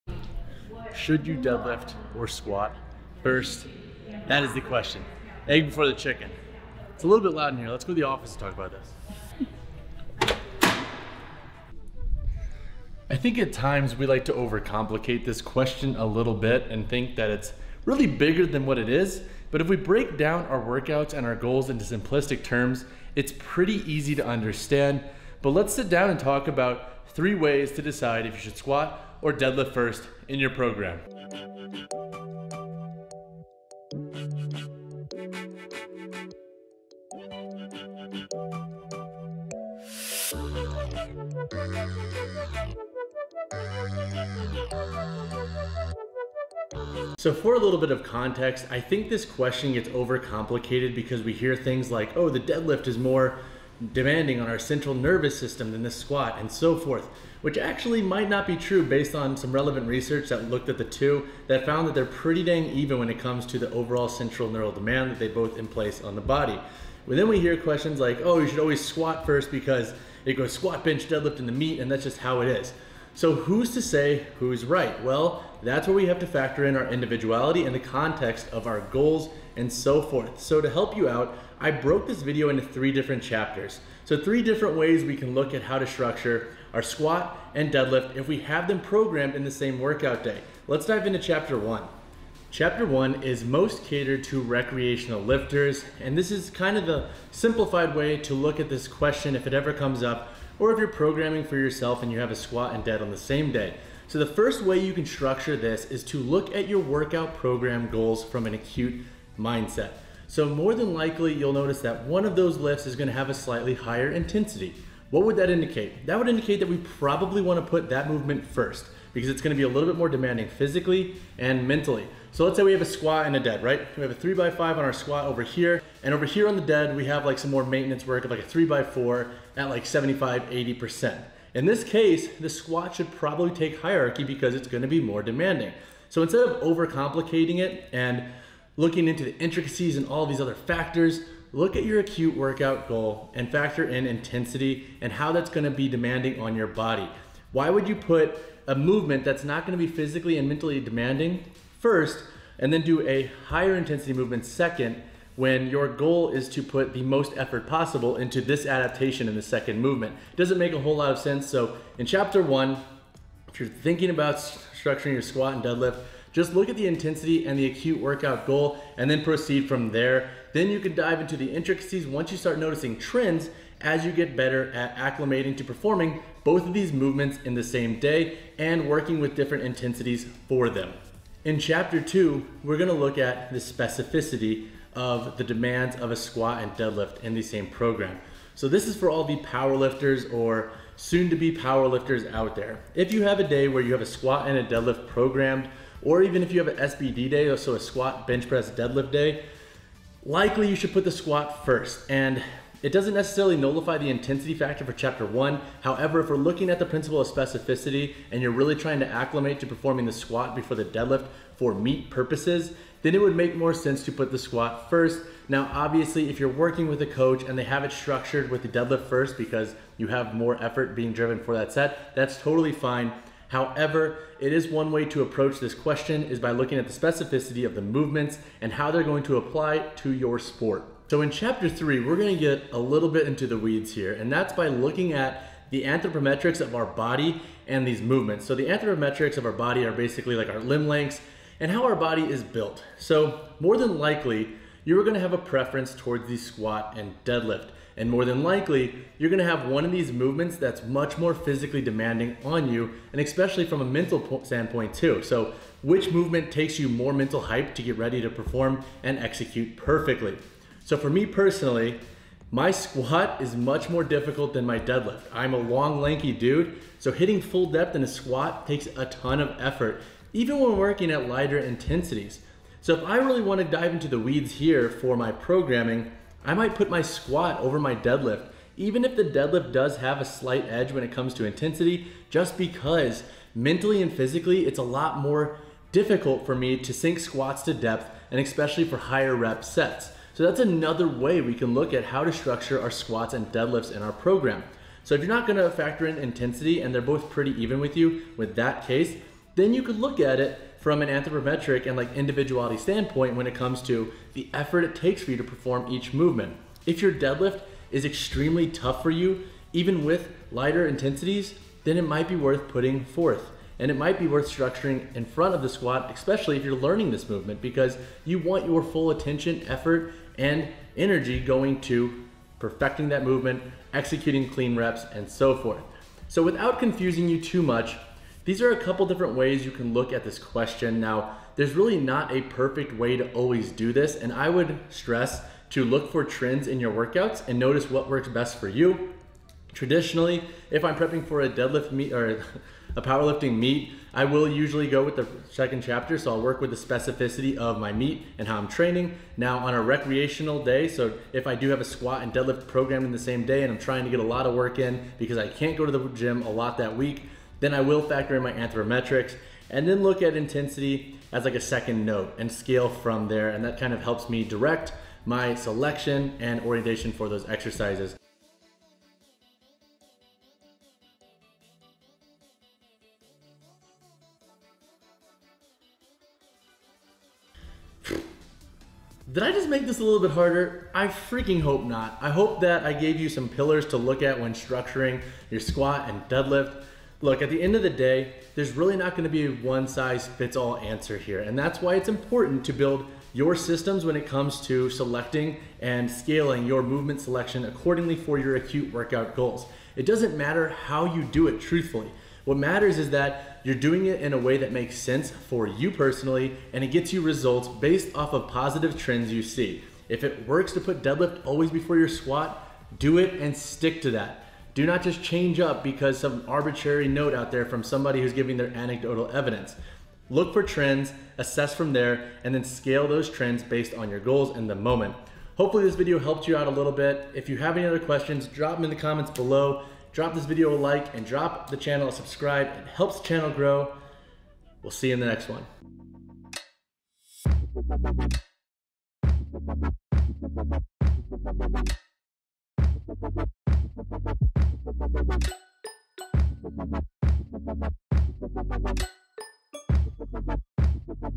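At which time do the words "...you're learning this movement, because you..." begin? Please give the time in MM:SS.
05:16.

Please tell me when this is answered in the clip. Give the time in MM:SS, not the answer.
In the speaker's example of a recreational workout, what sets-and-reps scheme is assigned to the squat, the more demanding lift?
02:04.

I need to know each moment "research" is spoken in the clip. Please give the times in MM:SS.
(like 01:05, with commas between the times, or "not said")
00:59.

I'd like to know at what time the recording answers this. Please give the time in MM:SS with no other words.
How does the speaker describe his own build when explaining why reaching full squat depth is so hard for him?
04:25.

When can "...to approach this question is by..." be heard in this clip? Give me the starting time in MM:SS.
03:45.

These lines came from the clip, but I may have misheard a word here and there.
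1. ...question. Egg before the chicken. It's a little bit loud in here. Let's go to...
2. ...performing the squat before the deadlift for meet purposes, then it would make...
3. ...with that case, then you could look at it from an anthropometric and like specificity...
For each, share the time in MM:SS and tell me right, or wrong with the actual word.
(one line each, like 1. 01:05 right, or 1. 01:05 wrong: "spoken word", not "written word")
1. 00:04 right
2. 03:29 right
3. 04:58 wrong: "individuality", not "specificity".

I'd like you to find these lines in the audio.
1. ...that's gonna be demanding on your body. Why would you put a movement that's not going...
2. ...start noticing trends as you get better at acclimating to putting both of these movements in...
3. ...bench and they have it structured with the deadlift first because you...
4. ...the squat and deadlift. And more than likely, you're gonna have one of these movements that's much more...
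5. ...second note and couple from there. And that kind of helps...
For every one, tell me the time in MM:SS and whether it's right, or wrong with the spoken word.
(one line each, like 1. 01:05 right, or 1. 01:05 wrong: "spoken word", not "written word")
1. 02:25 right
2. 02:52 wrong: "performing", not "putting"
3. 03:37 wrong: "coach", not "bench"
4. 04:06 right
5. 06:01 wrong: "scale", not "couple".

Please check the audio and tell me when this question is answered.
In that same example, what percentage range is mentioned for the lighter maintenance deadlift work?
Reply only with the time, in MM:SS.
02:09.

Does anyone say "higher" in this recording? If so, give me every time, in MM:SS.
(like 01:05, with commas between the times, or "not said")
01:53, 02:33, 04:48.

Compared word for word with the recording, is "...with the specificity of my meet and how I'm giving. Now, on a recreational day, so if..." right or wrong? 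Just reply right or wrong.
wrong.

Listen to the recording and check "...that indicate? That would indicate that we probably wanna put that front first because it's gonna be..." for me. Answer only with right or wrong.
wrong.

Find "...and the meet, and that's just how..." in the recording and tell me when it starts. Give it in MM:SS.
01:11.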